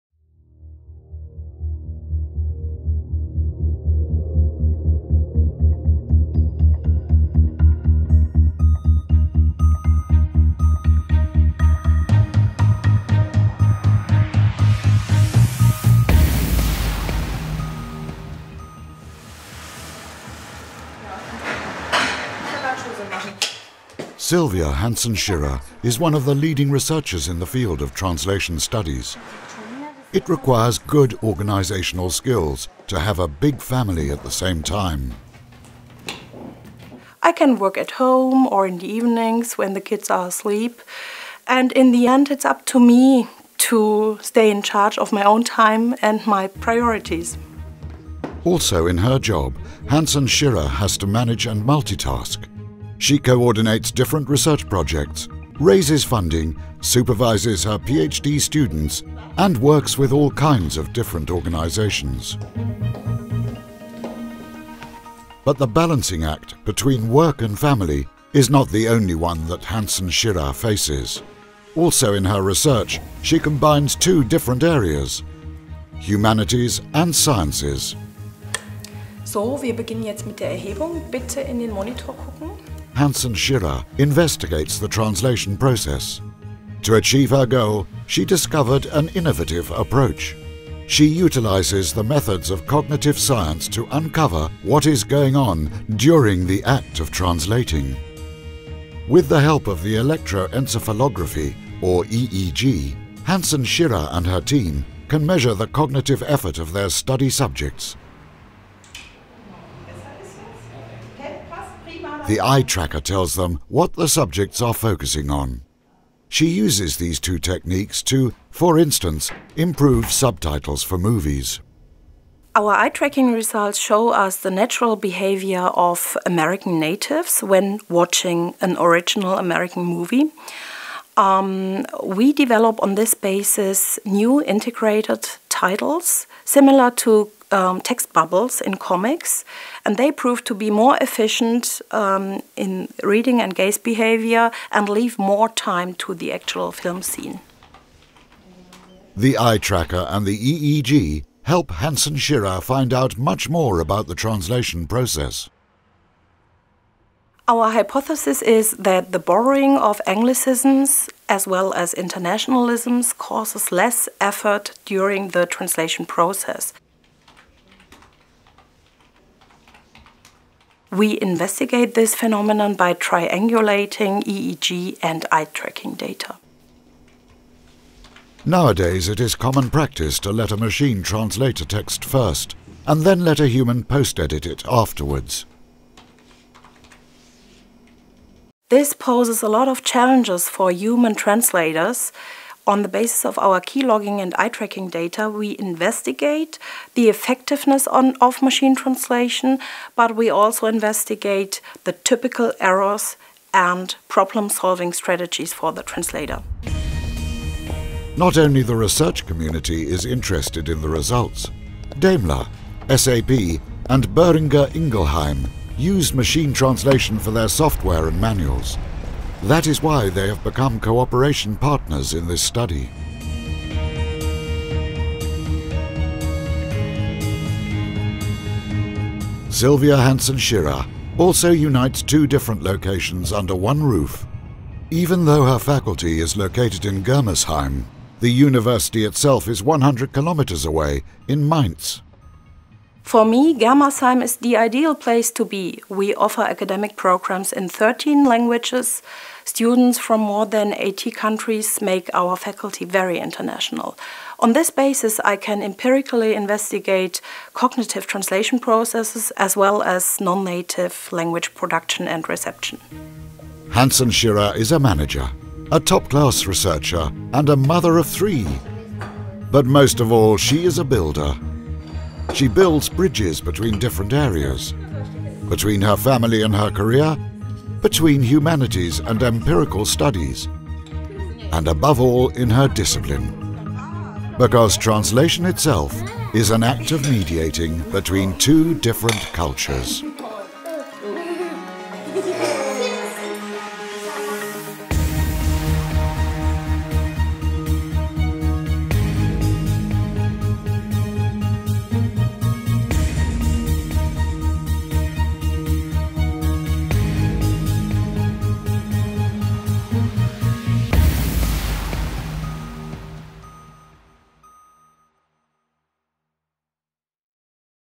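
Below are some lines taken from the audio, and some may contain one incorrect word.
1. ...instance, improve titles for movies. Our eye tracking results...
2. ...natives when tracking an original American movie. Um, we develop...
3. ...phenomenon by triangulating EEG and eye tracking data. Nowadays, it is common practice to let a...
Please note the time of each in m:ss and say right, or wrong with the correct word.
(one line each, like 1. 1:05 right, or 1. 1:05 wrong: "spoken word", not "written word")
1. 1:58 wrong: "subtitles", not "titles"
2. 2:06 wrong: "watching", not "tracking"
3. 2:52 right.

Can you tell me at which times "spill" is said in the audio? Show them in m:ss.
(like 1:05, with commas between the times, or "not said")
not said.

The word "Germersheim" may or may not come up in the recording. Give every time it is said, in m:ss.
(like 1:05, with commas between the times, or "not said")
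3:57, 4:03.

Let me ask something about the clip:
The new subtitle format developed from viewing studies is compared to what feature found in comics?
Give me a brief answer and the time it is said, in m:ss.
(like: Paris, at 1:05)
text bubbles, at 2:17.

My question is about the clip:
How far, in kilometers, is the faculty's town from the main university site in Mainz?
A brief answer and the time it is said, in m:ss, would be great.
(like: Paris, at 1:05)
100, at 3:59.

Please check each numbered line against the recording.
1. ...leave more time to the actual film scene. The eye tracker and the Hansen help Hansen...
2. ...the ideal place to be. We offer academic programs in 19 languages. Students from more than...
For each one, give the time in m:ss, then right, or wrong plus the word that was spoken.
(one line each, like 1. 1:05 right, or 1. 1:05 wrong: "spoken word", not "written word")
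1. 2:24 wrong: "EEG", not "Hansen"
2. 4:04 wrong: "13", not "19".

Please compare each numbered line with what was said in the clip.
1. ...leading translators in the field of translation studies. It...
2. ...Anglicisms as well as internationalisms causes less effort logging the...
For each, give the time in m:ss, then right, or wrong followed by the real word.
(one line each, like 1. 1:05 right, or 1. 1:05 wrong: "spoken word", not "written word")
1. 0:26 wrong: "researchers", not "translators"
2. 2:40 wrong: "during", not "logging".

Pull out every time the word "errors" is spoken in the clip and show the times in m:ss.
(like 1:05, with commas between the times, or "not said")
3:22.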